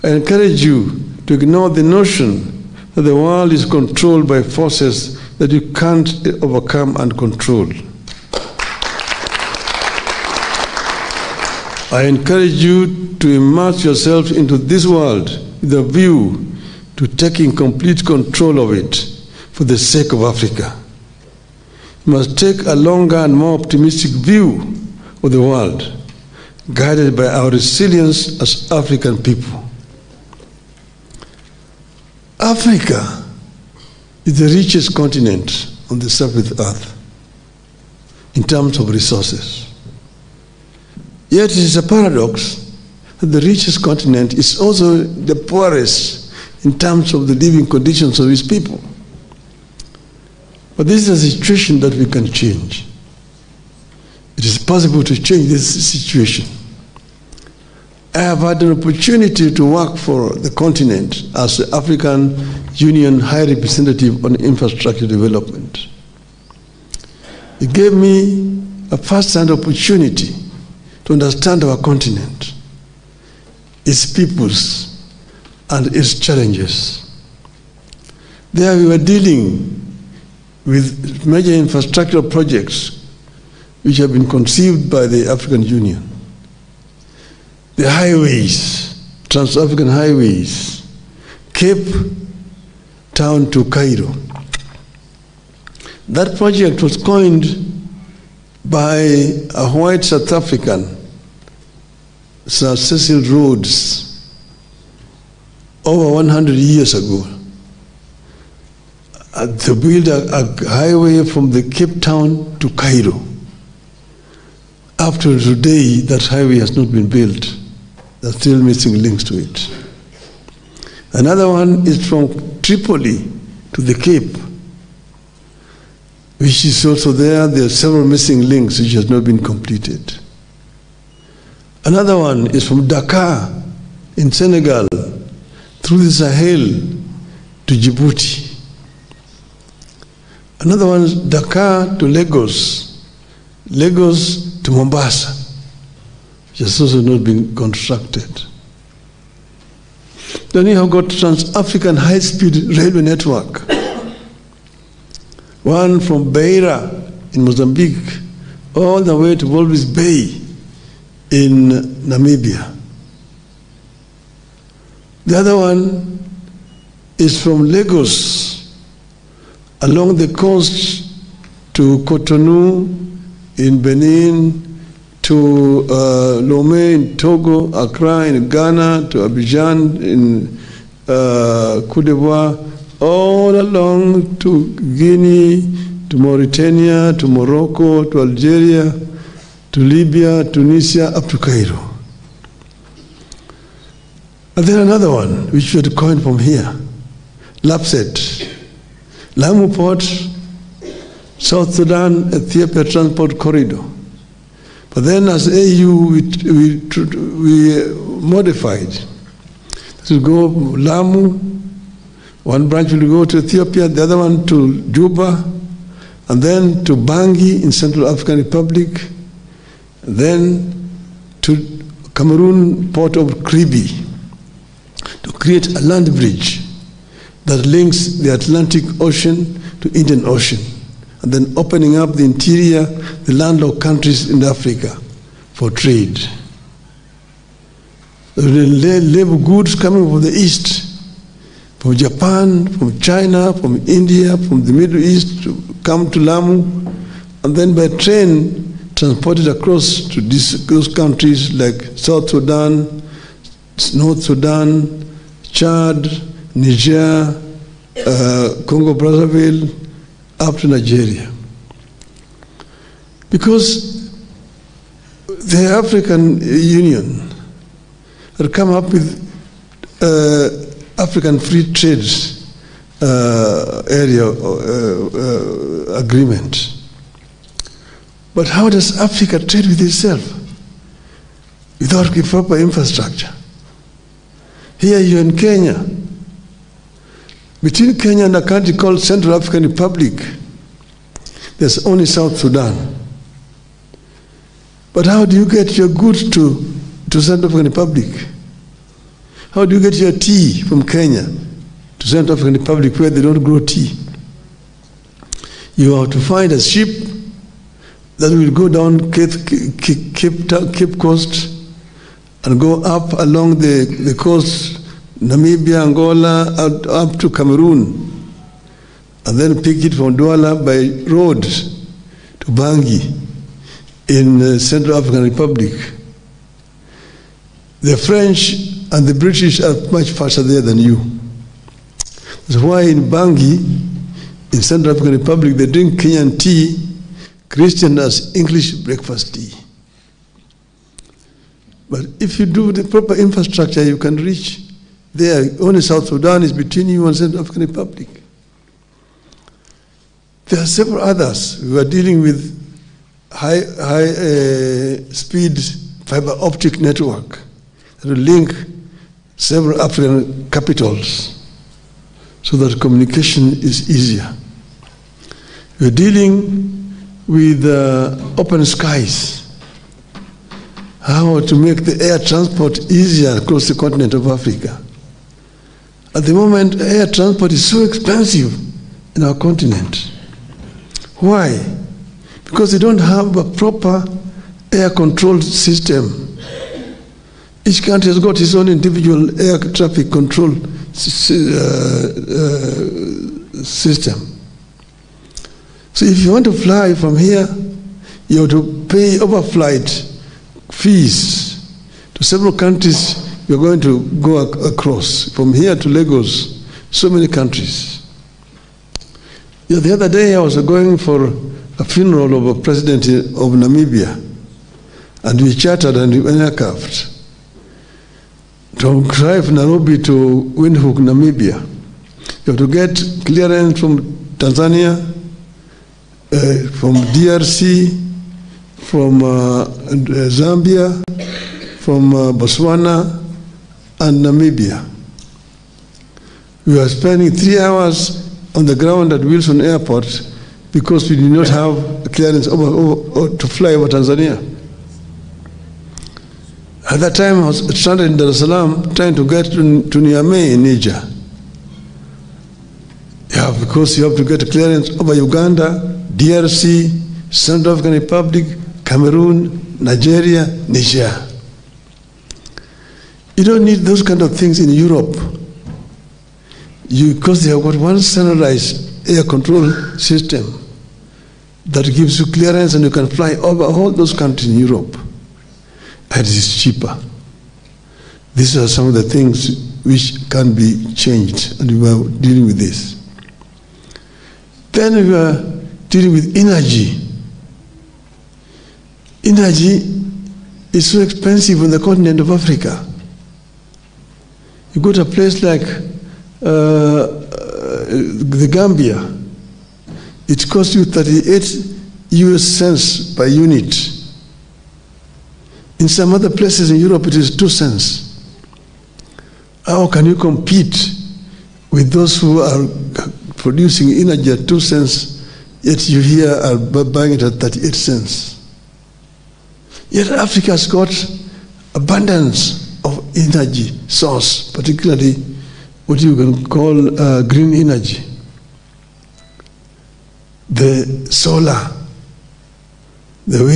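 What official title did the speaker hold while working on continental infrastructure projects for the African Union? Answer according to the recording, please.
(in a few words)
High Representative on Infrastructure Development.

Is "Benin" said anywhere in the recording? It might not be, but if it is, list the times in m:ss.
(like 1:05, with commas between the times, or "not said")
2:53.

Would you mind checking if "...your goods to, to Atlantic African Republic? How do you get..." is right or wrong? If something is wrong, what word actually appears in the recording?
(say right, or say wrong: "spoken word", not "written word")
wrong: "Central", not "Atlantic".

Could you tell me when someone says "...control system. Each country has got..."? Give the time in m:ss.
6:24.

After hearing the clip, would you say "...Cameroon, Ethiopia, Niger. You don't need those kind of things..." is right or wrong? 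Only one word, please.
wrong.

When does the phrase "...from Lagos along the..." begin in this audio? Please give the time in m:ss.
2:47.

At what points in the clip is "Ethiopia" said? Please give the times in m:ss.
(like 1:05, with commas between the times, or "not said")
3:22, 3:33.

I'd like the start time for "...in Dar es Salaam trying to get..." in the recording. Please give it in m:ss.
7:28.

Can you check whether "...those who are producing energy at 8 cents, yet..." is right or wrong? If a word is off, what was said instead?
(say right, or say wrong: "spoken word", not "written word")
wrong: "2", not "8".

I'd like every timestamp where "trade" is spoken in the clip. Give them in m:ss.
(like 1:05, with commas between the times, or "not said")
3:55, 4:31, 4:39.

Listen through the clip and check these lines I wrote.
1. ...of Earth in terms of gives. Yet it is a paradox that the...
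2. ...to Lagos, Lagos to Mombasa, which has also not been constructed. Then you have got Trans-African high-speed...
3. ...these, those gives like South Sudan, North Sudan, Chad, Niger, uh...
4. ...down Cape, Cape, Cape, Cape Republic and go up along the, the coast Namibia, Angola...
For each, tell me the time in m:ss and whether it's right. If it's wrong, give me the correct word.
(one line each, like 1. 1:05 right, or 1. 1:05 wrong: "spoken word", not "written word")
1. 0:36 wrong: "resources", not "gives"
2. 2:21 right
3. 4:10 wrong: "countries", not "gives"
4. 5:08 wrong: "Coast", not "Republic".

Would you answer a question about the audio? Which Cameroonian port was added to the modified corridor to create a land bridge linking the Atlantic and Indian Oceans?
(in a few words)
Kribi.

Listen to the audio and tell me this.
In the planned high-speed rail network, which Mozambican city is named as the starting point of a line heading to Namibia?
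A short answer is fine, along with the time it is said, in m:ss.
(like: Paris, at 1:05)
Beira, at 2:36.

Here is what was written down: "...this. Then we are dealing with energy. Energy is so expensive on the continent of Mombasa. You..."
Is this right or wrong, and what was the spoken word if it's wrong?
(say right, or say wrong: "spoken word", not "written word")
wrong: "Africa", not "Mombasa".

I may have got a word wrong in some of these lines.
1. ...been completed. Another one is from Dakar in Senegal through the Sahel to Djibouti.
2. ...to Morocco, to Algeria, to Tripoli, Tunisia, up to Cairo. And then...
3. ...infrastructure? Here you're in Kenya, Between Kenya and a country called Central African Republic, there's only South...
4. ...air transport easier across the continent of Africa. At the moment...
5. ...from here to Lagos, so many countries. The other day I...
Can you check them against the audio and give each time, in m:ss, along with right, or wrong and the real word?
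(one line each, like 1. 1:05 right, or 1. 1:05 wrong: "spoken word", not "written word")
1. 2:09 right
2. 3:07 wrong: "Libya", not "Tripoli"
3. 4:42 right
4. 6:12 right
5. 6:45 right.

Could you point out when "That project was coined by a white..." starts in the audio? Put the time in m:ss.
1:36.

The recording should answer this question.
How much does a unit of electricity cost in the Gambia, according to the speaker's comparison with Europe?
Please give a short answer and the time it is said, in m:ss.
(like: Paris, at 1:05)
38 US cents, at 8:20.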